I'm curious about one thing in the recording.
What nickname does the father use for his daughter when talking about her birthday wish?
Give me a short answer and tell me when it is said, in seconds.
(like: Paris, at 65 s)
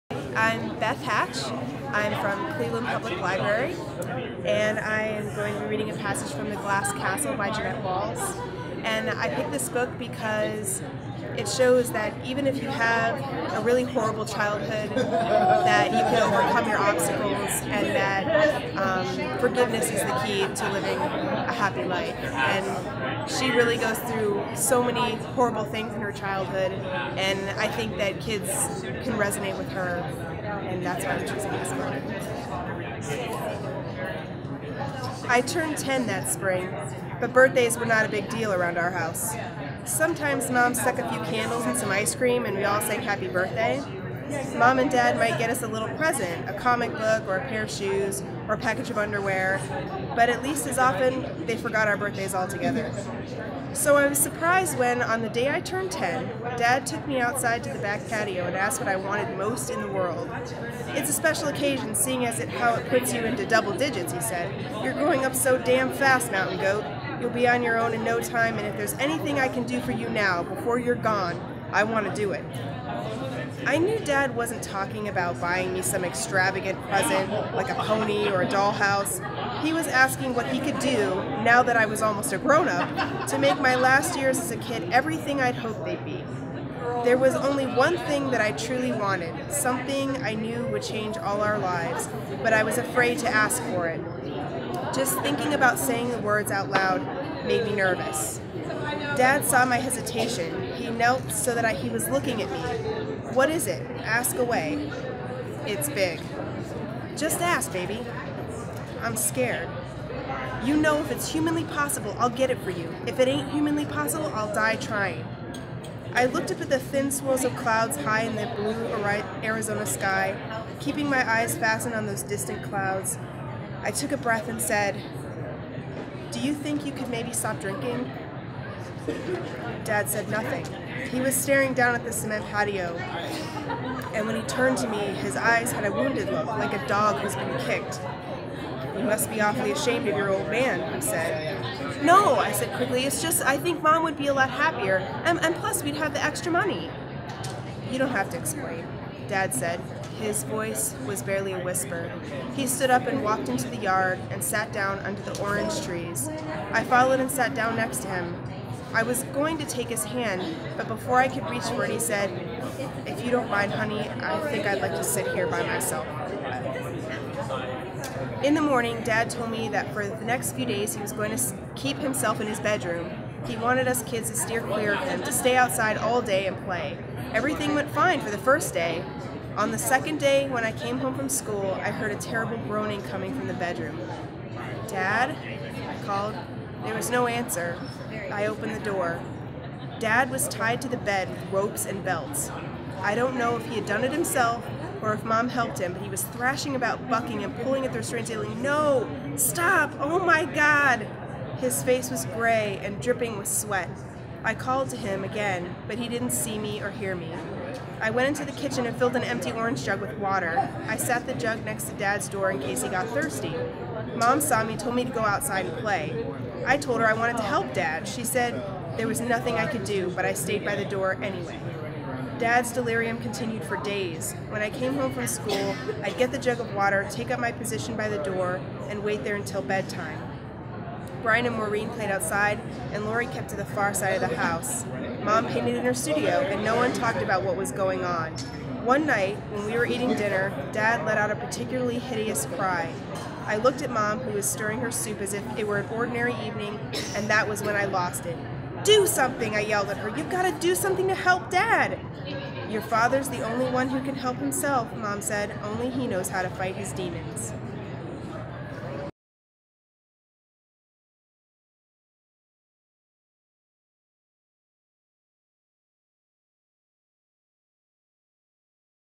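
Mountain Goat, at 66 s.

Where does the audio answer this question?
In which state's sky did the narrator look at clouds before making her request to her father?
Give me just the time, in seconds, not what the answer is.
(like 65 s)
119 s.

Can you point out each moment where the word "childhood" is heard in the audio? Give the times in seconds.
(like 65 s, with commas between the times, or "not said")
14 s, 26 s.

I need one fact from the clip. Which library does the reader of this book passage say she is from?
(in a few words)
Cleveland Public Library.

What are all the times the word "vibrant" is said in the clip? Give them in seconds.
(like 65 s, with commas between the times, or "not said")
not said.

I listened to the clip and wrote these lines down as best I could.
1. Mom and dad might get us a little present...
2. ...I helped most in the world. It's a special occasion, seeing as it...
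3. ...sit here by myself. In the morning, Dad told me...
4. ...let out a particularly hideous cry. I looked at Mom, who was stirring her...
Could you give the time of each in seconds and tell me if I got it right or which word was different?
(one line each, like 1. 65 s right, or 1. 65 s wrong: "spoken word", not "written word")
1. 44 s right
2. 58 s wrong: "wanted", not "helped"
3. 165 s right
4. 241 s right.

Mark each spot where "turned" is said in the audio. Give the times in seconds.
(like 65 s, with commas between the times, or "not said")
35 s, 55 s, 134 s.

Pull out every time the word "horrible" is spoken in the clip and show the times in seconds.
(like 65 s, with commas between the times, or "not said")
13 s, 25 s.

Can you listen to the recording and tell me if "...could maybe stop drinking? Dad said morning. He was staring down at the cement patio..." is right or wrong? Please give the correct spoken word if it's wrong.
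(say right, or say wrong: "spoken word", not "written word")
wrong: "nothing", not "morning".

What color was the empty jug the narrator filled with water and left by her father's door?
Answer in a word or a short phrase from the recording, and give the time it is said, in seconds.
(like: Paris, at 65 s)
orange jug, at 209 s.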